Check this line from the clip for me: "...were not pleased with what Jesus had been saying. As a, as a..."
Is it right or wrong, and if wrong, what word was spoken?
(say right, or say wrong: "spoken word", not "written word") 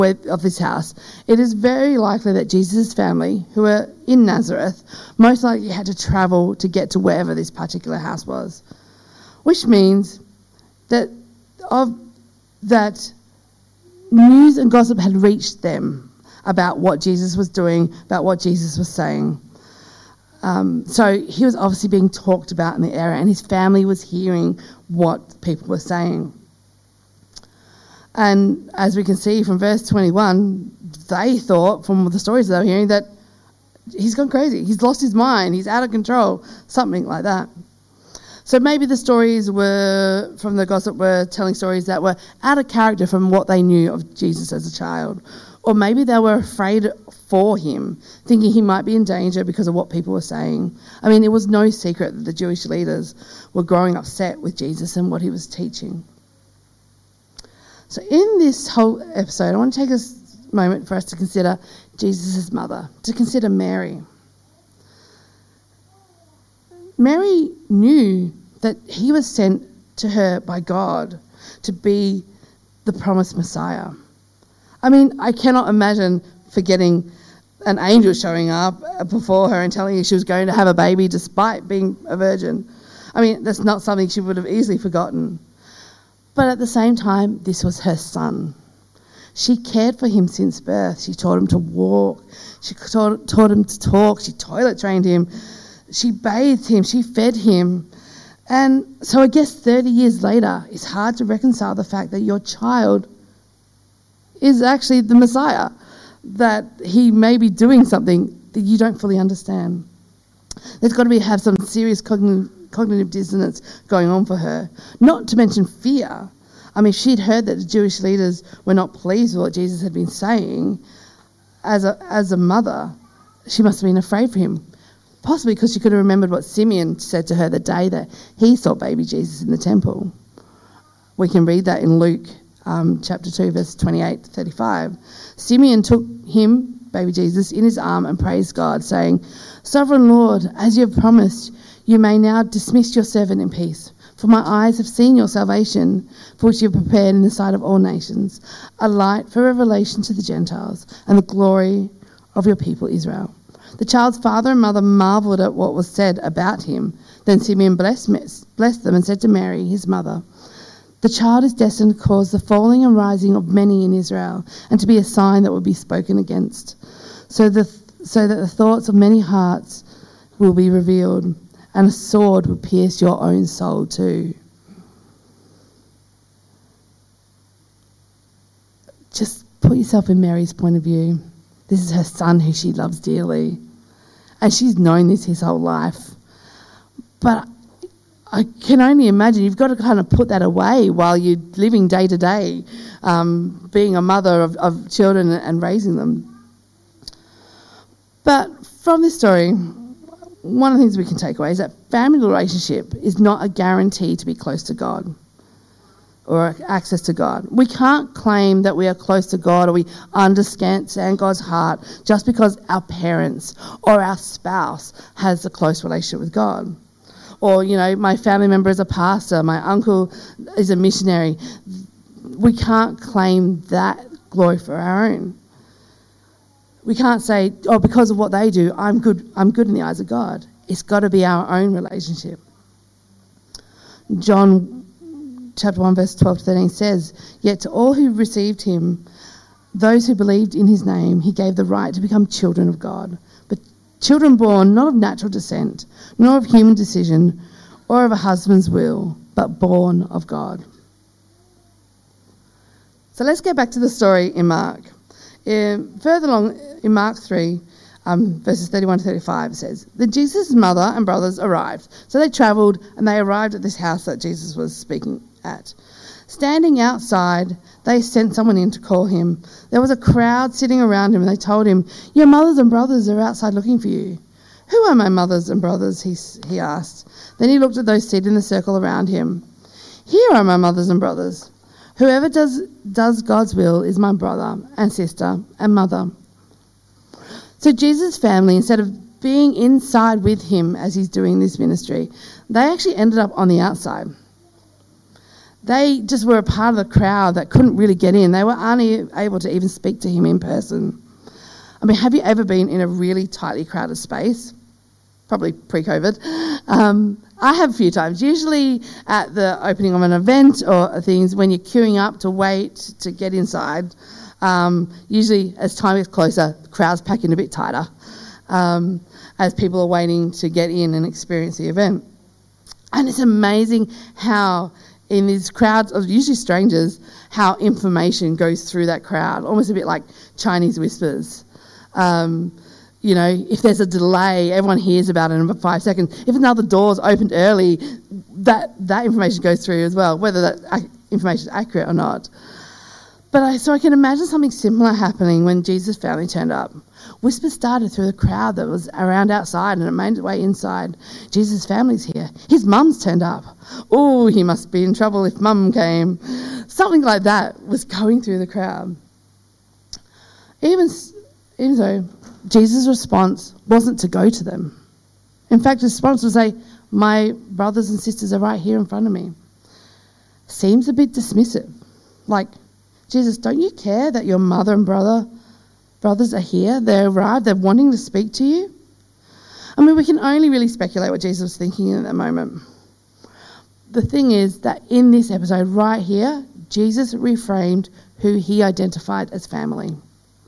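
right.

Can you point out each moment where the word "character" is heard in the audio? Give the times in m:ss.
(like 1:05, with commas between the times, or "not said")
0:42.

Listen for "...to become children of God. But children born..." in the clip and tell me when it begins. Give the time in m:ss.
4:01.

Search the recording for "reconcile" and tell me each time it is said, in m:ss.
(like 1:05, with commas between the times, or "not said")
1:41.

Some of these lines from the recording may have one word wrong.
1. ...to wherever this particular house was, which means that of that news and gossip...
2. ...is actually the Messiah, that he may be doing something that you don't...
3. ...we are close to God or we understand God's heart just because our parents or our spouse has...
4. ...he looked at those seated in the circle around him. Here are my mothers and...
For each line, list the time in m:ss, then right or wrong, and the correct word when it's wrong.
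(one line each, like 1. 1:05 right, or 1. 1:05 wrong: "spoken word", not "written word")
1. 0:06 right
2. 1:44 right
3. 3:28 right
4. 4:37 right.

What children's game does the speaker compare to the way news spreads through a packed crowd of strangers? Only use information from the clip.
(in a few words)
Chinese whispers.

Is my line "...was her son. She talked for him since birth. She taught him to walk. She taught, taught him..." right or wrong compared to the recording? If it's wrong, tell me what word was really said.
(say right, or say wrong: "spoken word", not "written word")
wrong: "cared", not "talked".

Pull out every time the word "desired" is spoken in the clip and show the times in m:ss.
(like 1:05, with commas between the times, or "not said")
not said.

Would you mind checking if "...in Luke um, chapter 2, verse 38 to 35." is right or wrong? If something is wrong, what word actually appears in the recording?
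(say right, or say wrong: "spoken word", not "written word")
wrong: "28", not "38".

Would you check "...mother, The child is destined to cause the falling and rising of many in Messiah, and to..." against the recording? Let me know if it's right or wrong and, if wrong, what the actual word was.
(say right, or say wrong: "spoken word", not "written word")
wrong: "Israel", not "Messiah".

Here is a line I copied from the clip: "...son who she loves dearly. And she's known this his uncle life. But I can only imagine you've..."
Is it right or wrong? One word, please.
wrong.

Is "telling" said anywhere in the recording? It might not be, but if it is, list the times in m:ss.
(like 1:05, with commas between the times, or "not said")
0:41, 1:19.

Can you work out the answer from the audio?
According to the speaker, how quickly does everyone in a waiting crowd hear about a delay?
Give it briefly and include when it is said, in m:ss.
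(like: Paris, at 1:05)
5 seconds, at 5:35.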